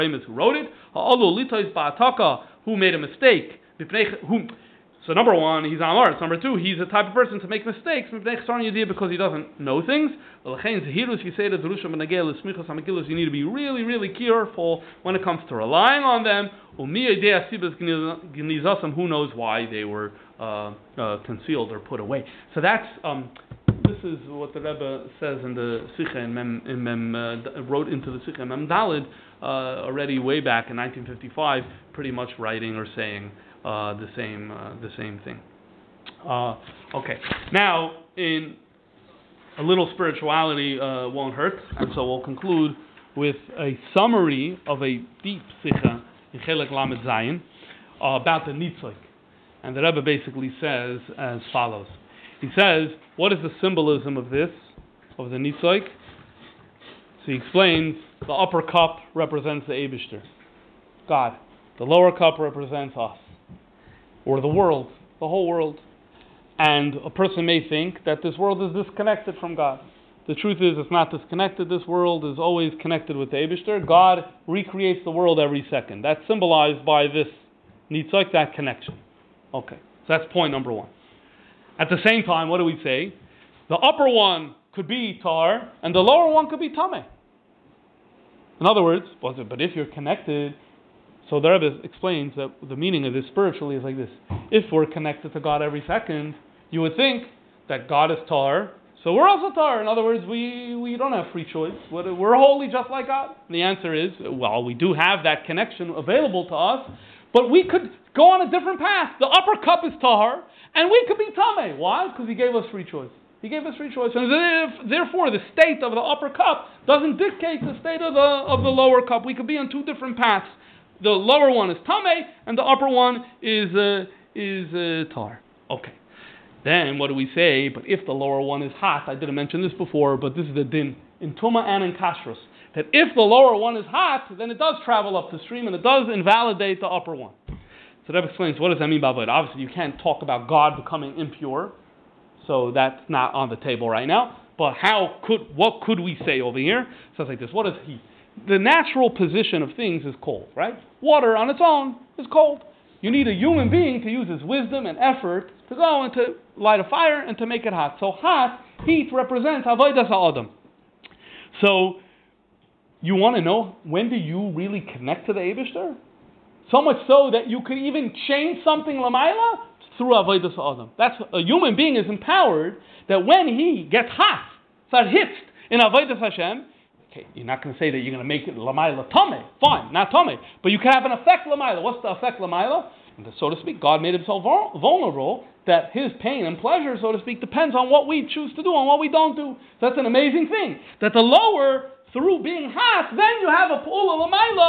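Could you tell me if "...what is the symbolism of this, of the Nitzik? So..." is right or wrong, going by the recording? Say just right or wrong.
right.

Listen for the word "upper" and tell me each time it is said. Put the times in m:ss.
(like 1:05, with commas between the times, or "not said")
0:58, 1:23, 1:49, 1:56, 2:02, 2:16.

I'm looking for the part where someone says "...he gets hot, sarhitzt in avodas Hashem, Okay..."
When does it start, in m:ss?
2:53.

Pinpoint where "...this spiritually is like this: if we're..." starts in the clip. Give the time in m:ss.
1:33.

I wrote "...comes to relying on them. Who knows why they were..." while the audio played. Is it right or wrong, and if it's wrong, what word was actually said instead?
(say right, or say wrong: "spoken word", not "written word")
right.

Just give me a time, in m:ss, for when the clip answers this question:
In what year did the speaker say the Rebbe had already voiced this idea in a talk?
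0:30.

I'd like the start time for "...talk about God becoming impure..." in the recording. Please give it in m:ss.
2:20.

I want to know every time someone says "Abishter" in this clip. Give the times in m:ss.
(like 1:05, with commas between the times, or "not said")
0:59, 1:13, 2:45.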